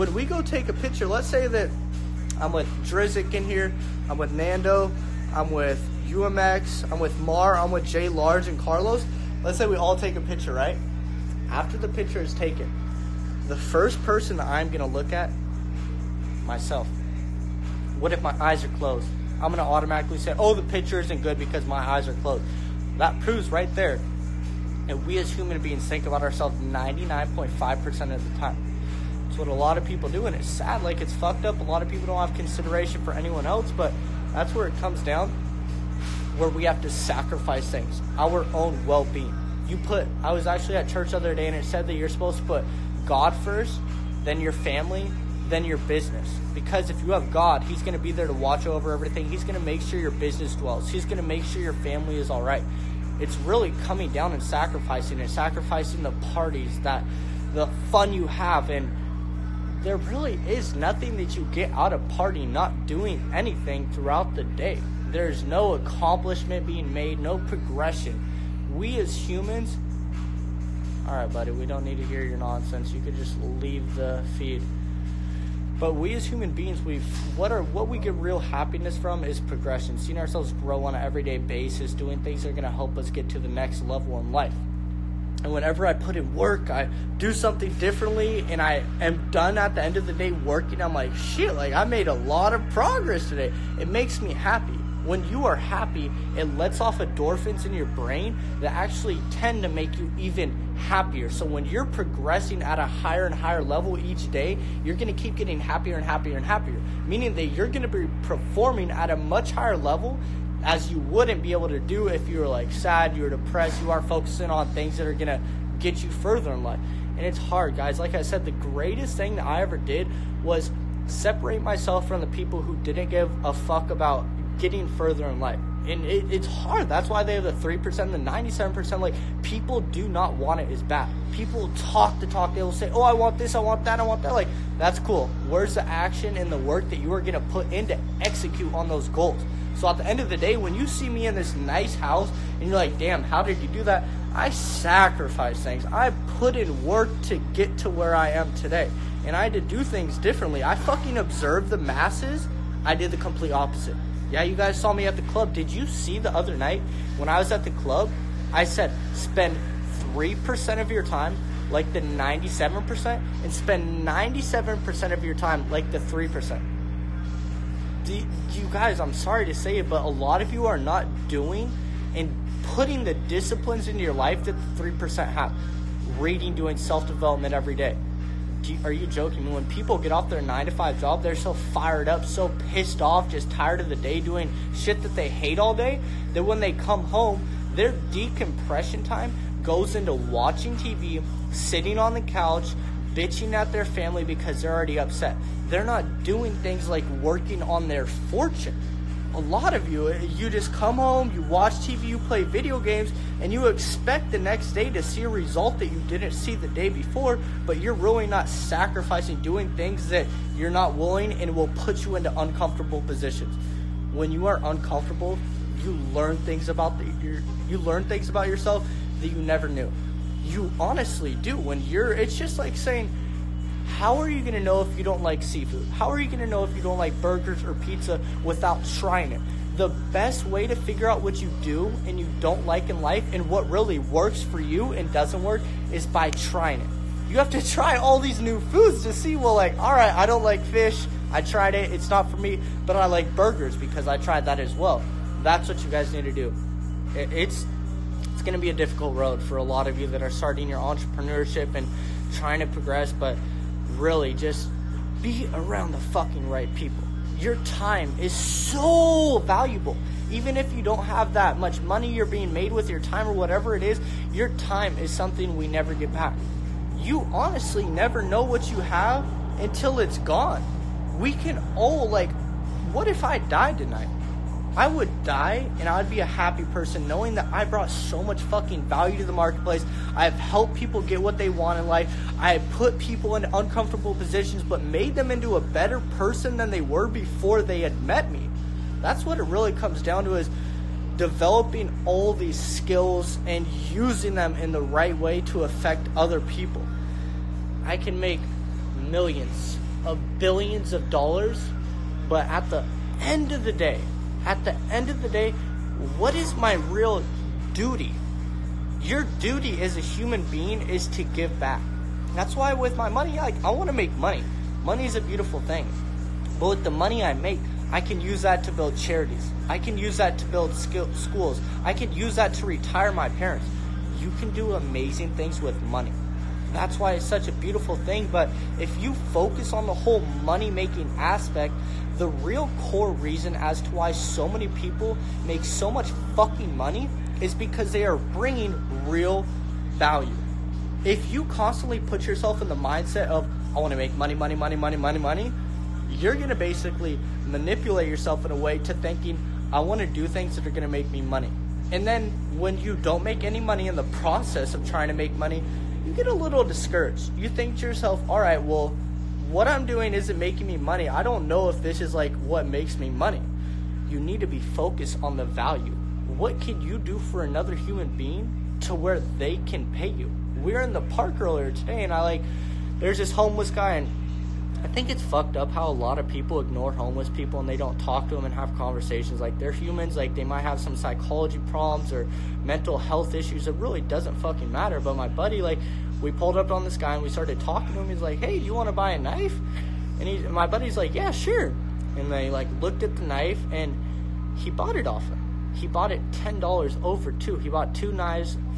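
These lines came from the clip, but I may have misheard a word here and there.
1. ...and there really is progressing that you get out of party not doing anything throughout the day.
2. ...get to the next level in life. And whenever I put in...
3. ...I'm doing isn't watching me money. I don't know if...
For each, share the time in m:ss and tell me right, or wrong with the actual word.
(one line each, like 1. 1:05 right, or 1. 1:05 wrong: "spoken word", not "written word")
1. 0:58 wrong: "nothing", not "progressing"
2. 1:23 right
3. 5:59 wrong: "making", not "watching".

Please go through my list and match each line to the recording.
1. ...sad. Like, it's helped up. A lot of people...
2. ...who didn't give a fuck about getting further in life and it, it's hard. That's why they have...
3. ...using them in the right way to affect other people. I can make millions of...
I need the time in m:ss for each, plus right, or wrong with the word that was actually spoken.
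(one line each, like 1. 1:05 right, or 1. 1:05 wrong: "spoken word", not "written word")
1. 0:30 wrong: "fucked", not "helped"
2. 2:02 right
3. 4:53 right.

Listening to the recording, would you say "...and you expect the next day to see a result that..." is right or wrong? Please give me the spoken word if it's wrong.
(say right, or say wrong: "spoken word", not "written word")
right.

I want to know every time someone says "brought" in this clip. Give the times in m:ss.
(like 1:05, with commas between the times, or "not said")
4:37.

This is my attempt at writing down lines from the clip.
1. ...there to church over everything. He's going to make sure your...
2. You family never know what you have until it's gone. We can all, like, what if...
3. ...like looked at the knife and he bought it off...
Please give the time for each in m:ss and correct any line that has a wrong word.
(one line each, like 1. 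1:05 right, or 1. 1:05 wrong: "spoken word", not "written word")
1. 0:48 wrong: "watch", not "church"
2. 4:26 wrong: "honestly", not "family"
3. 6:32 right.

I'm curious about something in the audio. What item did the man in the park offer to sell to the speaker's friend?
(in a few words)
a knife.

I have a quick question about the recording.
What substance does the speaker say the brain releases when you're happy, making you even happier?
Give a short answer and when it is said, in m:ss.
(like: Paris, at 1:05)
endorphins, at 1:36.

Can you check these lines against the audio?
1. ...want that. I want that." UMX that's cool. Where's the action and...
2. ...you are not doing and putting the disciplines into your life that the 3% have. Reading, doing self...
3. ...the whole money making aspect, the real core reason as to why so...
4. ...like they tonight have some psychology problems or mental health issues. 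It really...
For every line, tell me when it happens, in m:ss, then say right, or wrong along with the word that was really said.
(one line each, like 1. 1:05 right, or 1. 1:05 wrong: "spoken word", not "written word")
1. 2:13 wrong: "Like", not "UMX"
2. 2:50 right
3. 5:29 right
4. 6:20 wrong: "might", not "tonight".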